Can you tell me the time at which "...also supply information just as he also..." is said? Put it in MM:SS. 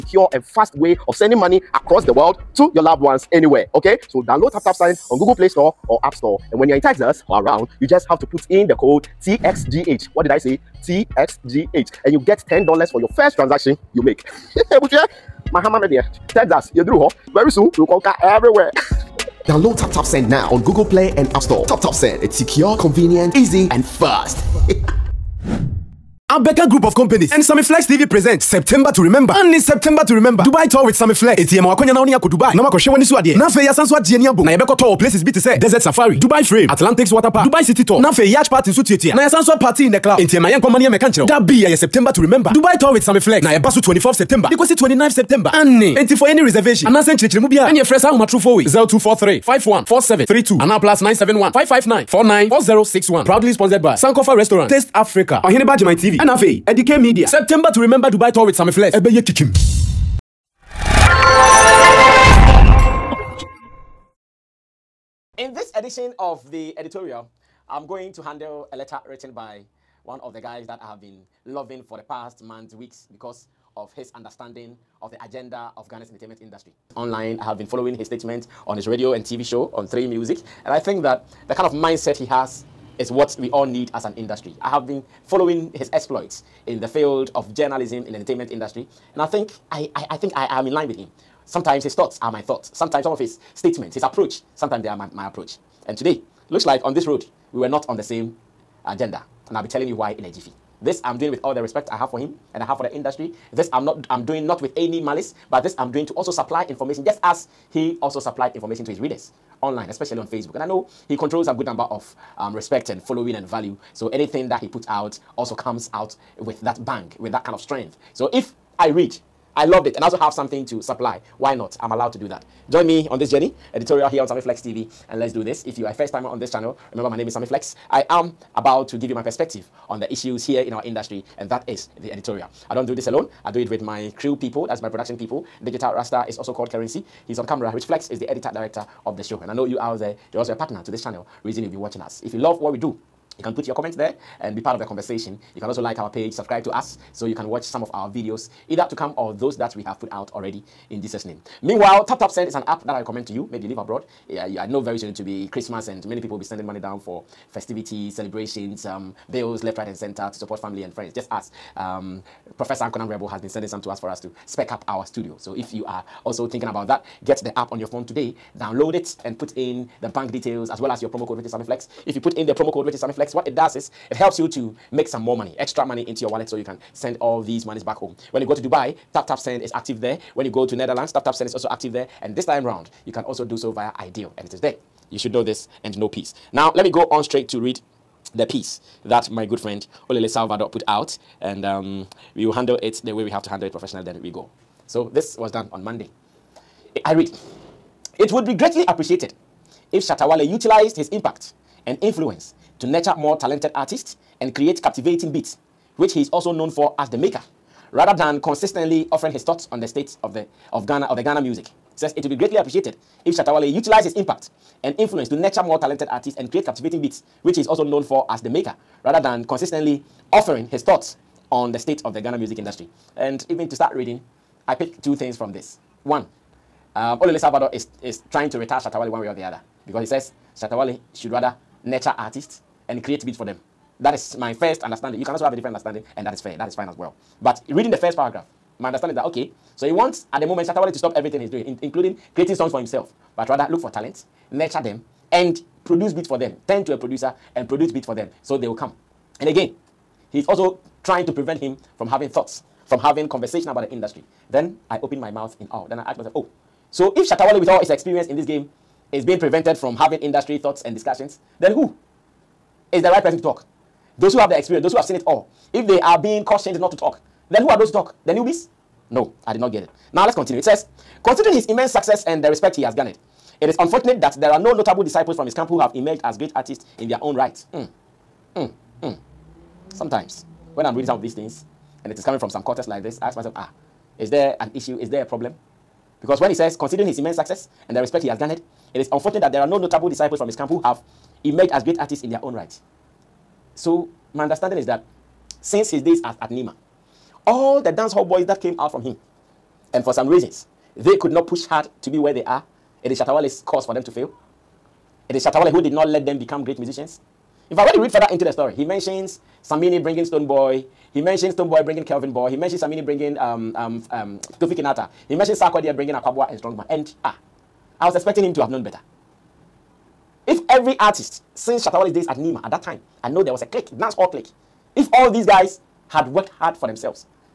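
01:46.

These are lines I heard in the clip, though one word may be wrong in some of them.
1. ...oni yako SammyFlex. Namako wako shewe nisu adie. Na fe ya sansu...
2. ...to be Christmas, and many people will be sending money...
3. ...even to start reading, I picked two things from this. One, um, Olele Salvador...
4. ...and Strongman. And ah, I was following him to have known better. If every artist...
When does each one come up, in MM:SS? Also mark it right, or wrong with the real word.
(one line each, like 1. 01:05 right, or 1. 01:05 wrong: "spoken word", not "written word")
1. 00:32 wrong: "Dubai", not "SammyFlex"
2. 02:35 right
3. 03:43 right
4. 05:16 wrong: "expecting", not "following".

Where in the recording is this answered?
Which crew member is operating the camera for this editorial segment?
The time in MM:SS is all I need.
02:15.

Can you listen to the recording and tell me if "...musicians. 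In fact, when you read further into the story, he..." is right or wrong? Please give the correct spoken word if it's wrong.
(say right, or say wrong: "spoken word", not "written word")
right.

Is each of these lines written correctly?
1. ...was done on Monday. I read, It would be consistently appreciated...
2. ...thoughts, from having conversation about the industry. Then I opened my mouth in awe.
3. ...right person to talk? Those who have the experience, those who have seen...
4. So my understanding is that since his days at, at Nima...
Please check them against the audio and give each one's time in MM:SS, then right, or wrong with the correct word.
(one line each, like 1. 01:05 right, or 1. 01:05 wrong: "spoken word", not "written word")
1. 03:15 wrong: "greatly", not "consistently"
2. 04:12 right
3. 04:23 right
4. 04:53 right.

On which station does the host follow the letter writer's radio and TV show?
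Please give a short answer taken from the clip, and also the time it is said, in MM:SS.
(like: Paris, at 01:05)
3 Music, at 01:19.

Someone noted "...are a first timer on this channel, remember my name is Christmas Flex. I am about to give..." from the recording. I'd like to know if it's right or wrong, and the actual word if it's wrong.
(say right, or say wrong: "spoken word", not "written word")
wrong: "Sammy", not "Christmas".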